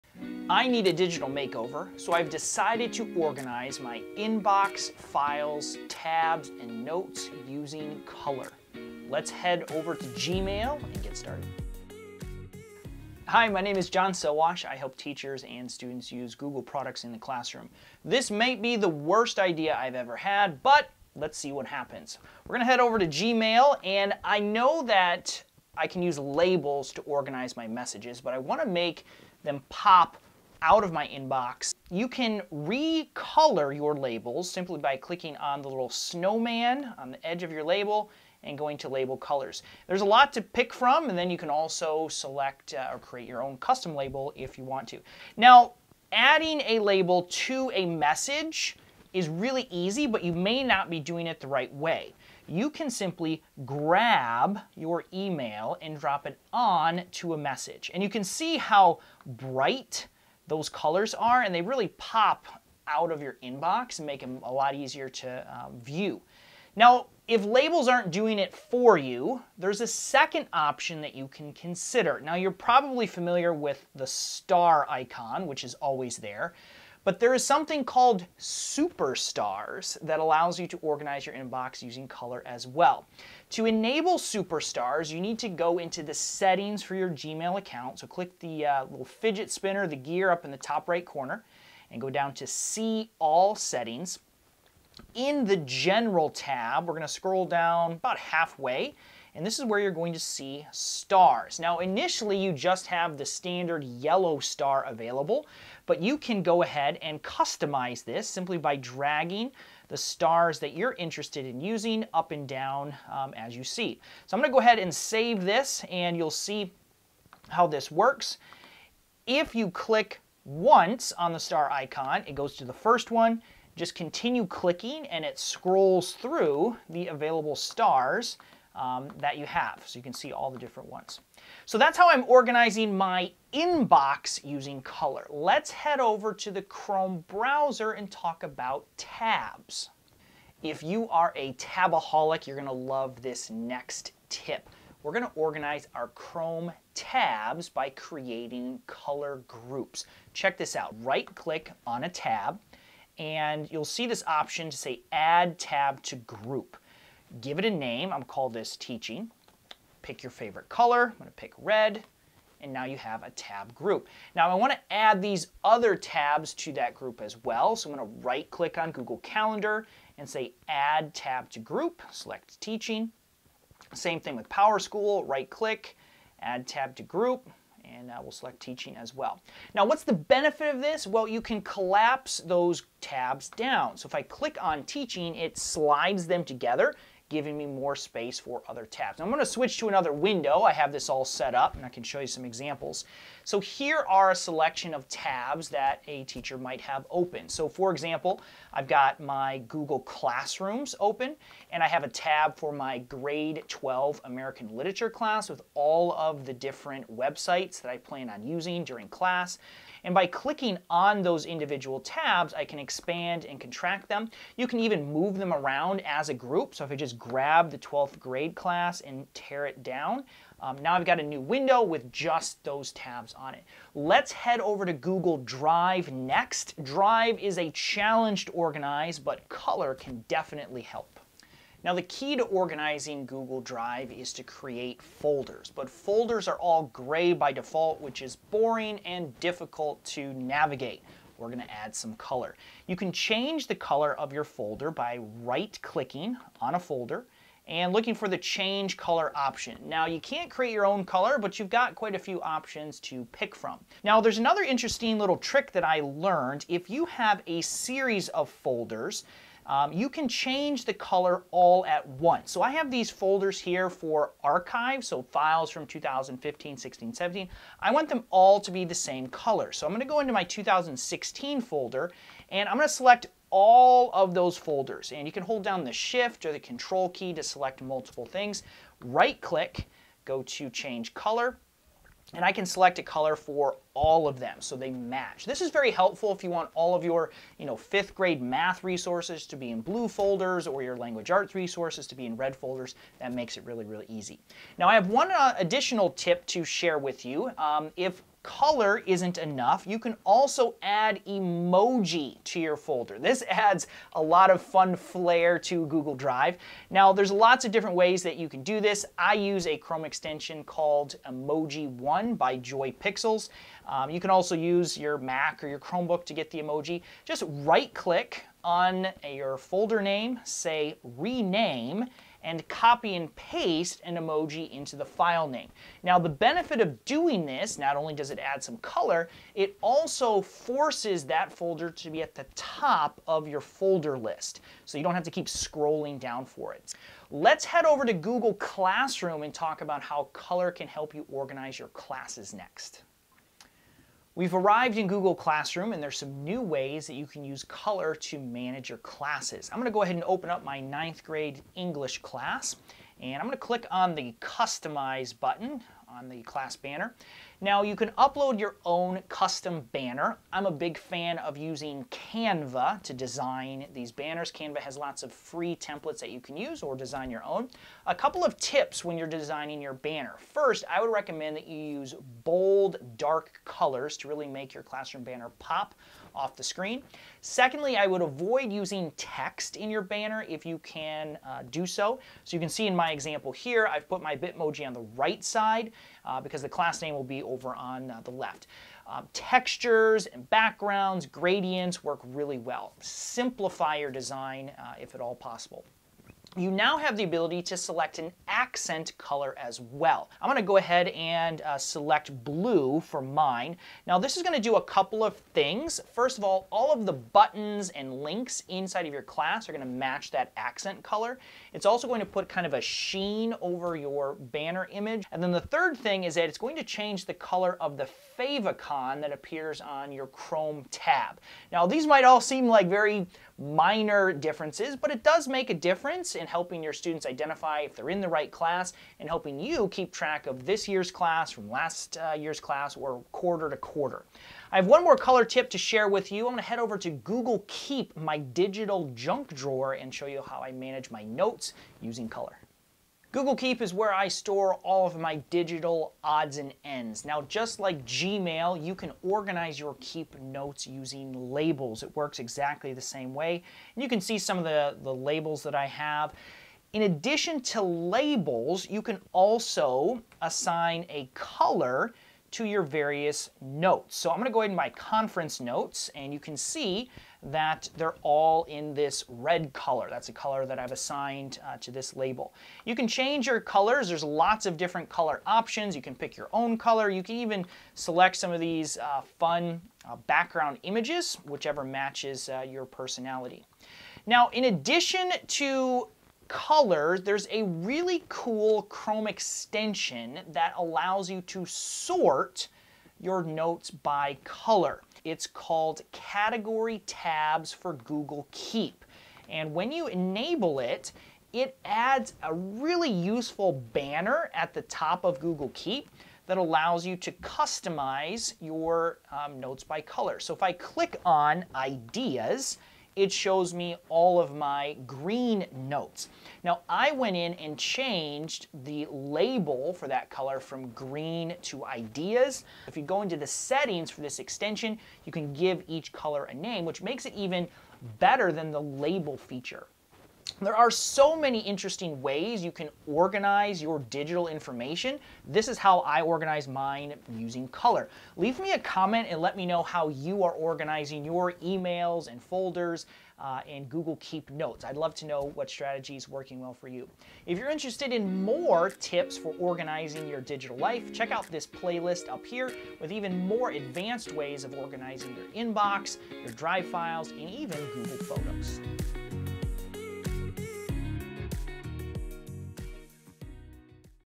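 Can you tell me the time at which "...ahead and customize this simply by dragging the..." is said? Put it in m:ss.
1:46.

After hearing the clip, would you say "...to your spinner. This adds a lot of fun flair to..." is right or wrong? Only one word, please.
wrong.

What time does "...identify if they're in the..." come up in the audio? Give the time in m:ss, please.
7:07.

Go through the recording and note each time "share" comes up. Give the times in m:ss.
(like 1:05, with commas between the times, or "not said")
4:56, 7:15.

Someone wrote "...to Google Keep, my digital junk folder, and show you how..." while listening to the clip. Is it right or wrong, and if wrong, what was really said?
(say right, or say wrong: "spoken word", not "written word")
wrong: "drawer", not "folder".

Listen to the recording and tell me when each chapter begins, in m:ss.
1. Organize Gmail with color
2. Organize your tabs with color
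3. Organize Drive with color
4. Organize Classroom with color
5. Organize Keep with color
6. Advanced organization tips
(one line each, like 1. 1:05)
1. 0:23
2. 2:14
3. 3:45
4. 5:38
5. 7:15
6. 8:50.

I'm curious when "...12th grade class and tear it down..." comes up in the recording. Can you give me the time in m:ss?
3:37.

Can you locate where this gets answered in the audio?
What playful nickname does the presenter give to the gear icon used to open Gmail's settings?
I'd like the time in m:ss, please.
1:28.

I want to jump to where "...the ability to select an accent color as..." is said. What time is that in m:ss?
6:37.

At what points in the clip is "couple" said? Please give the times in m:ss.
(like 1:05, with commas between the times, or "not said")
6:08, 6:44.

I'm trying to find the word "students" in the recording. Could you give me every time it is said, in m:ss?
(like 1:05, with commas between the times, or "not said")
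0:15, 7:06.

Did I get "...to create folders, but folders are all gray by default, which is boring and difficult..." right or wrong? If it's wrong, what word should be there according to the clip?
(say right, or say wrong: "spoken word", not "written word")
right.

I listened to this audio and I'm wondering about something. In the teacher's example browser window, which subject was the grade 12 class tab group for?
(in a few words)
American literature.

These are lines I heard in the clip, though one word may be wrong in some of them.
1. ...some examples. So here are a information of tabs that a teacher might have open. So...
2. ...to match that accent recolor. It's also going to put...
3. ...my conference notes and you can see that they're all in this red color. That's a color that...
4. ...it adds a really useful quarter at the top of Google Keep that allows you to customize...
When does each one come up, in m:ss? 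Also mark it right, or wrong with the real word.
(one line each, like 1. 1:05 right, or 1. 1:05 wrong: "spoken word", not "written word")
1. 3:12 wrong: "selection", not "information"
2. 6:49 wrong: "color", not "recolor"
3. 7:44 right
4. 8:21 wrong: "banner", not "quarter".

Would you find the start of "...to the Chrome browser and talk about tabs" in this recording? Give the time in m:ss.
2:16.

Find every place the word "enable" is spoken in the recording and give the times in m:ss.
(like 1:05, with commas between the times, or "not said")
1:23, 8:20.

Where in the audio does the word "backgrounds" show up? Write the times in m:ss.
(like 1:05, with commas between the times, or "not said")
6:30, 8:00.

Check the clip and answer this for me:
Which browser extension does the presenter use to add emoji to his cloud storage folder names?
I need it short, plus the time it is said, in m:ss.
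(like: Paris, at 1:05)
Emoji One, at 5:11.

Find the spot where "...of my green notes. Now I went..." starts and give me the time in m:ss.
8:34.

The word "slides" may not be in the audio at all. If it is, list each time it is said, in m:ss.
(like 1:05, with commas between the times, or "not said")
3:05.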